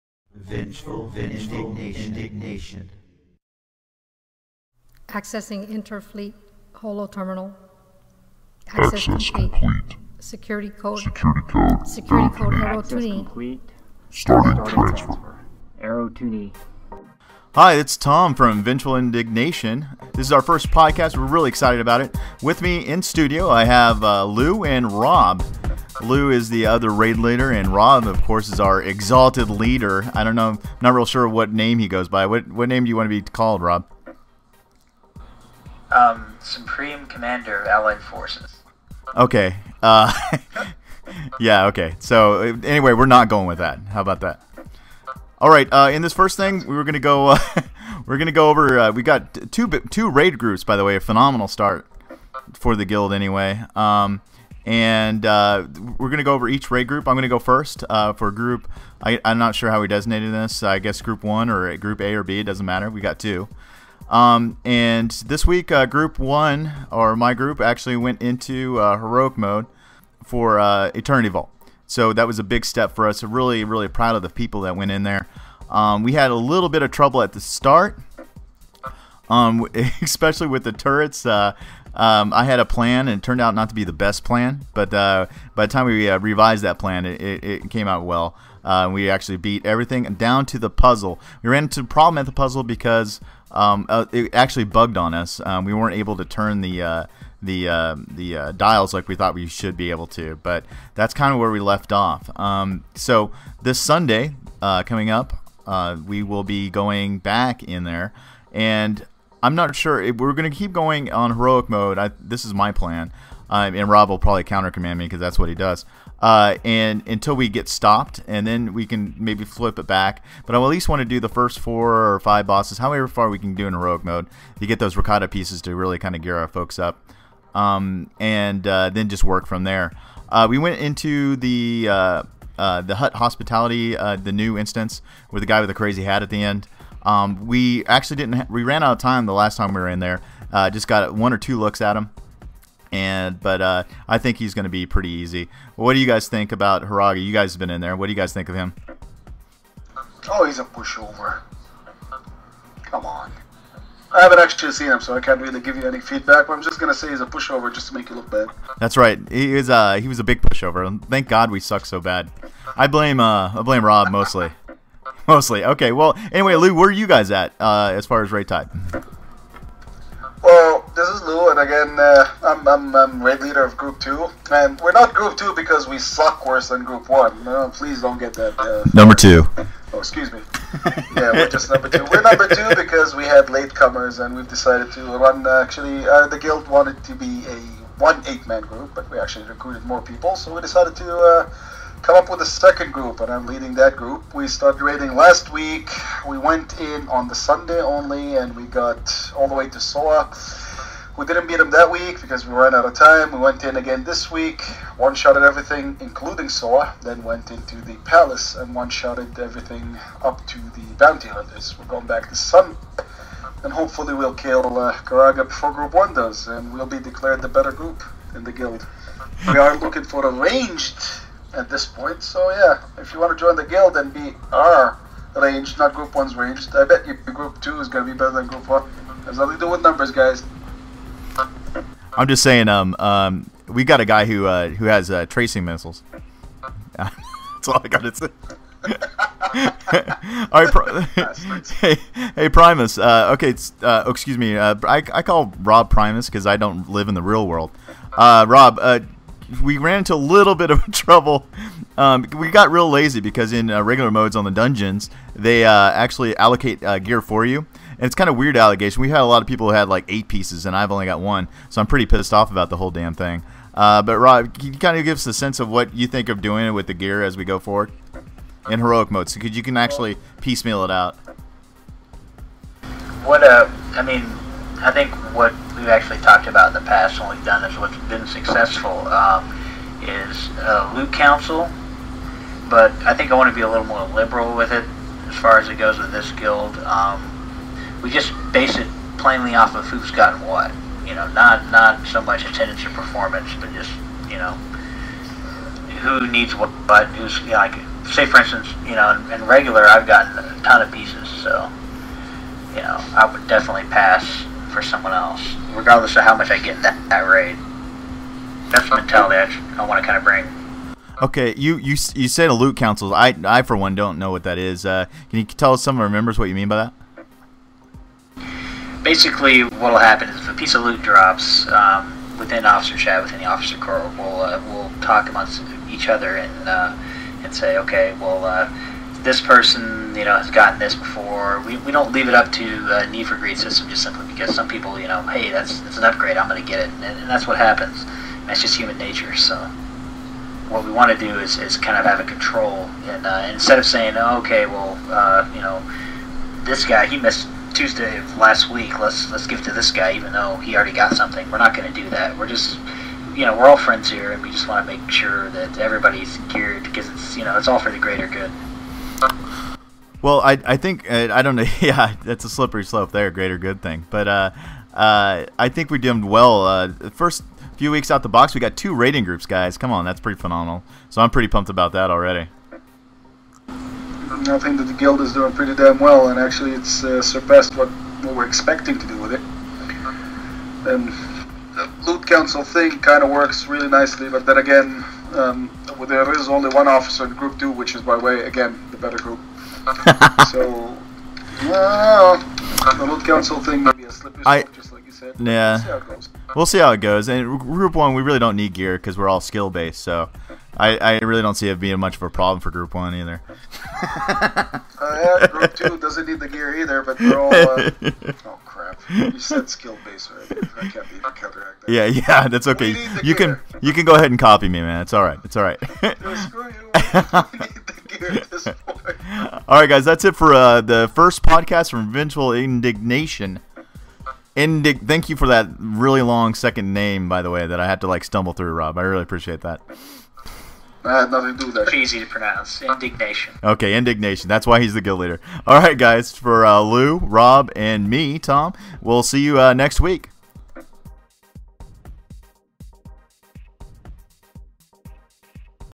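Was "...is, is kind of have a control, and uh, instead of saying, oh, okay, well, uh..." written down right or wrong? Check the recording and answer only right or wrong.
right.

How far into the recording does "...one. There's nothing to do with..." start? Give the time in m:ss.
3:48.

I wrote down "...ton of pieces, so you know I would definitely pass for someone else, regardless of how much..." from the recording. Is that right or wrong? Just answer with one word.
right.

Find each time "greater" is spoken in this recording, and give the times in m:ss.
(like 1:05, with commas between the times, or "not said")
5:57, 6:03.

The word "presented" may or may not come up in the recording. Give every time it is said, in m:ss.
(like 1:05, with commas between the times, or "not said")
not said.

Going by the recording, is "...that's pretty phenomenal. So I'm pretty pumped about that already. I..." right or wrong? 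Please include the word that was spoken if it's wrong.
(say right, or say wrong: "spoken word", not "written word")
right.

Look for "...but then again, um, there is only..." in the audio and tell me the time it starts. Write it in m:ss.
6:24.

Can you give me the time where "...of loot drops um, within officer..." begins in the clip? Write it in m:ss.
5:20.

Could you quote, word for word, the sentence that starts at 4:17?
And it's kind of weird allegation.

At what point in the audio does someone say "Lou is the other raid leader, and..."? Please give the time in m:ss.
0:26.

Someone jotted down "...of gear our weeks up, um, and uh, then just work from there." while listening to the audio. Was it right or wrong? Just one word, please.
wrong.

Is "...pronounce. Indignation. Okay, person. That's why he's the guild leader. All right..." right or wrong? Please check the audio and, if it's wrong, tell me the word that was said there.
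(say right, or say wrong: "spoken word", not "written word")
wrong: "indignation", not "person".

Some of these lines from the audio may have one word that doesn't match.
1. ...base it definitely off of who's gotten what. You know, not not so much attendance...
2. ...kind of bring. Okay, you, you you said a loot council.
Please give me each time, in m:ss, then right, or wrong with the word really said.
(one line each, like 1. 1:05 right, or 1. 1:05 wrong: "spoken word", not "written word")
1. 4:48 wrong: "plainly", not "definitely"
2. 5:10 right.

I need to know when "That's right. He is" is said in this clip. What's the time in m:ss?
2:38.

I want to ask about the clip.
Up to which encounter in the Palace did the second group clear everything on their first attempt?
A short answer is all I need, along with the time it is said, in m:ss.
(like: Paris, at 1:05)
the Bounty Hunters, at 3:30.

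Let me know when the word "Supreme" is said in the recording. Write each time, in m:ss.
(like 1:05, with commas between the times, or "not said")
0:36.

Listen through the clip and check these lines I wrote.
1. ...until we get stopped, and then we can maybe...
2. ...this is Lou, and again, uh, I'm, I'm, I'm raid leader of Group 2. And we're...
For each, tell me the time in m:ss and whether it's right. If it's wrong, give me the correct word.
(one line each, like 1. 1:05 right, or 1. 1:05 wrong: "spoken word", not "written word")
1. 1:57 right
2. 2:50 right.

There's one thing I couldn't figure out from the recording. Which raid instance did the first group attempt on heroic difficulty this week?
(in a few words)
Eternity Vault.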